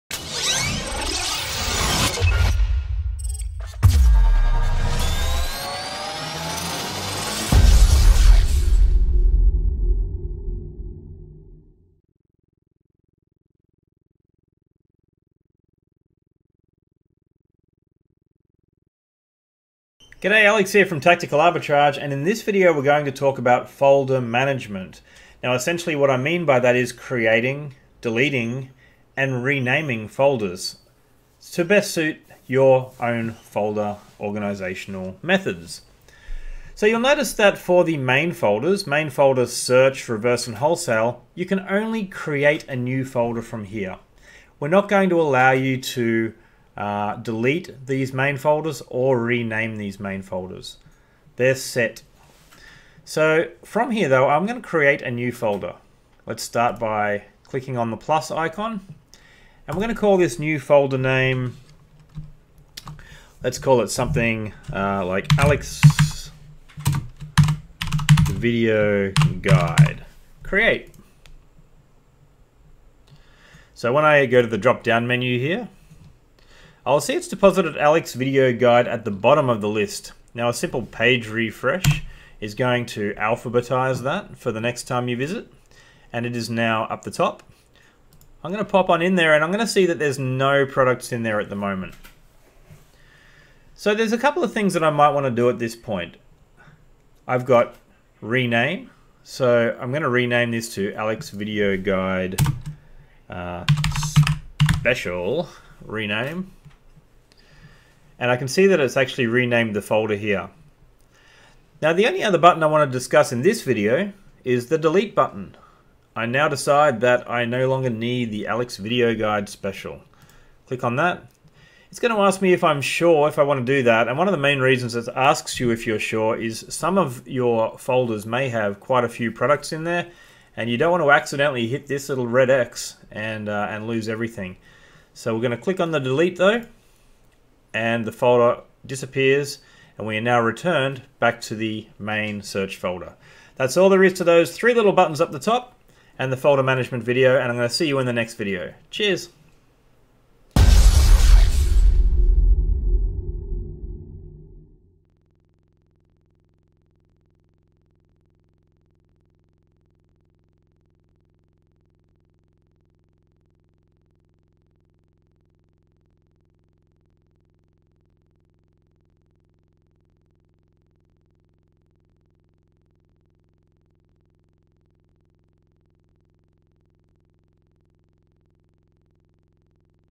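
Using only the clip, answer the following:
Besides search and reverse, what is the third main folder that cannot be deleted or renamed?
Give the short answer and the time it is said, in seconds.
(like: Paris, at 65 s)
wholesale, at 40 s.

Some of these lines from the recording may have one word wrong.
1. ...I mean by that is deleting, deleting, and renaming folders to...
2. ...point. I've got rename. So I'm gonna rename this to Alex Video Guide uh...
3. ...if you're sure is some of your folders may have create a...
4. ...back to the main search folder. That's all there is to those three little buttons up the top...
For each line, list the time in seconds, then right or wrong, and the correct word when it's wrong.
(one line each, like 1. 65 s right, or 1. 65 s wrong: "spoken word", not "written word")
1. 26 s wrong: "creating", not "deleting"
2. 95 s right
3. 125 s wrong: "quite", not "create"
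4. 141 s right.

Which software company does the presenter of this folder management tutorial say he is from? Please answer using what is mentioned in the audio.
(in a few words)
Tactical Arbitrage.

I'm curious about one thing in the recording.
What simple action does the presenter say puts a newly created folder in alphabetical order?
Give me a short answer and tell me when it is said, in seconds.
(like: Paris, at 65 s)
page refresh, at 80 s.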